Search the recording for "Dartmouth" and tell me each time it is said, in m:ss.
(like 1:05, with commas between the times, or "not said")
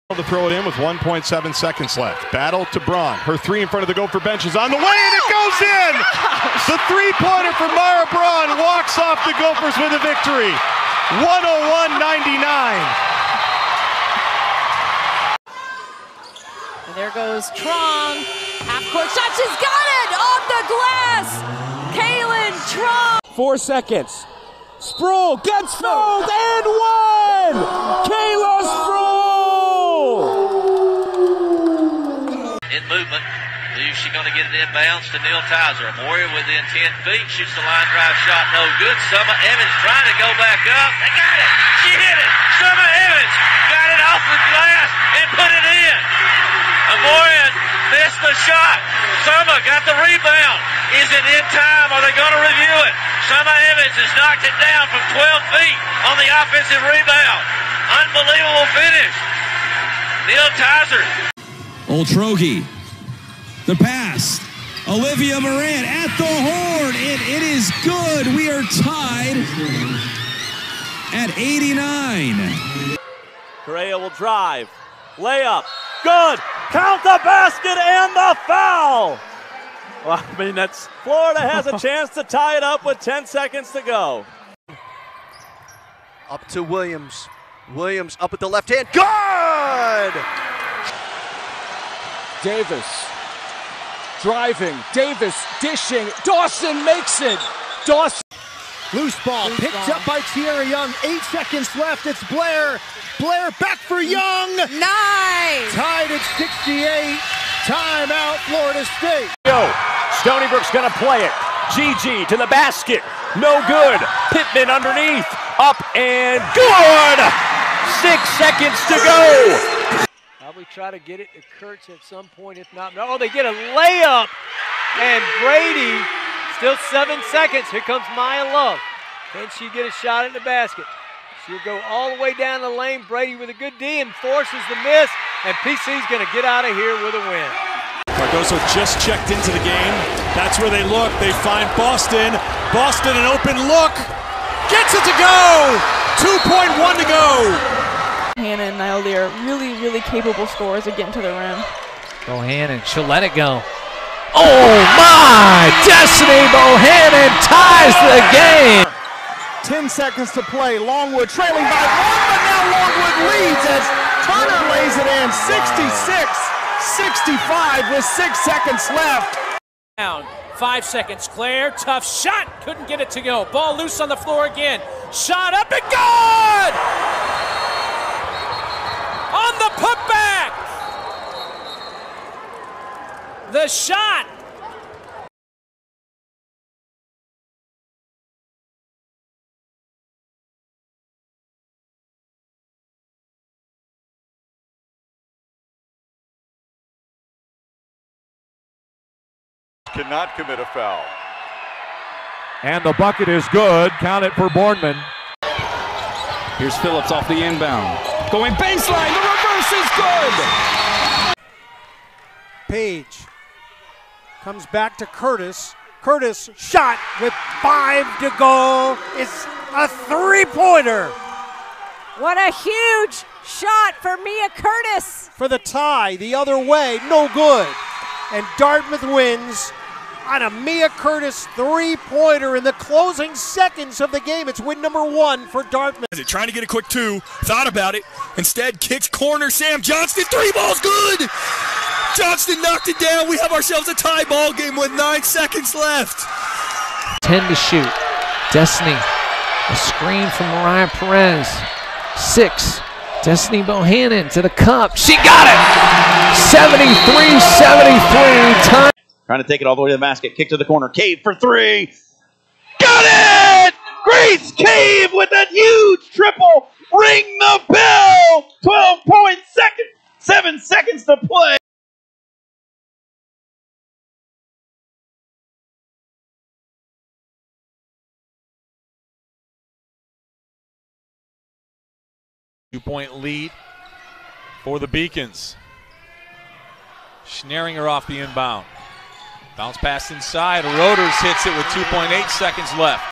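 3:48, 3:55.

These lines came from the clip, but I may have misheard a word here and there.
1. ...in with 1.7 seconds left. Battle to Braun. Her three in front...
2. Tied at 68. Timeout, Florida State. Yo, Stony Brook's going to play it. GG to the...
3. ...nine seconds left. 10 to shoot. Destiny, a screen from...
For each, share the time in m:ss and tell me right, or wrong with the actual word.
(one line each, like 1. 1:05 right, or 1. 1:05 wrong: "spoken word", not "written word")
1. 0:00 right
2. 1:45 right
3. 4:04 right.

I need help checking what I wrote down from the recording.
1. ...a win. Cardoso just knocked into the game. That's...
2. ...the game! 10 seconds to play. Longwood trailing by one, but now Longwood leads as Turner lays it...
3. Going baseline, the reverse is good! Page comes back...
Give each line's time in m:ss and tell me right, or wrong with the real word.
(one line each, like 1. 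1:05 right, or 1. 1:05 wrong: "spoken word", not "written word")
1. 2:17 wrong: "checked", not "knocked"
2. 2:38 right
3. 3:28 right.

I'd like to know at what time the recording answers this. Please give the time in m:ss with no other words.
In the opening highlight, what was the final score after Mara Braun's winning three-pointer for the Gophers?
0:11.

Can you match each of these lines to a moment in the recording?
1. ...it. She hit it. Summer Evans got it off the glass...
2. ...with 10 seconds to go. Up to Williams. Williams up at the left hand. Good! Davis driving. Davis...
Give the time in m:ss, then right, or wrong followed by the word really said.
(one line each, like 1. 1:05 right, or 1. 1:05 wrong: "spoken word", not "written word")
1. 0:41 right
2. 1:22 right.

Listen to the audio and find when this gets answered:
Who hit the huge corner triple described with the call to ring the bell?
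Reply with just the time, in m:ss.
4:24.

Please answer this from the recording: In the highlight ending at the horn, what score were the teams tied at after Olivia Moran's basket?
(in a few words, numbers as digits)
89.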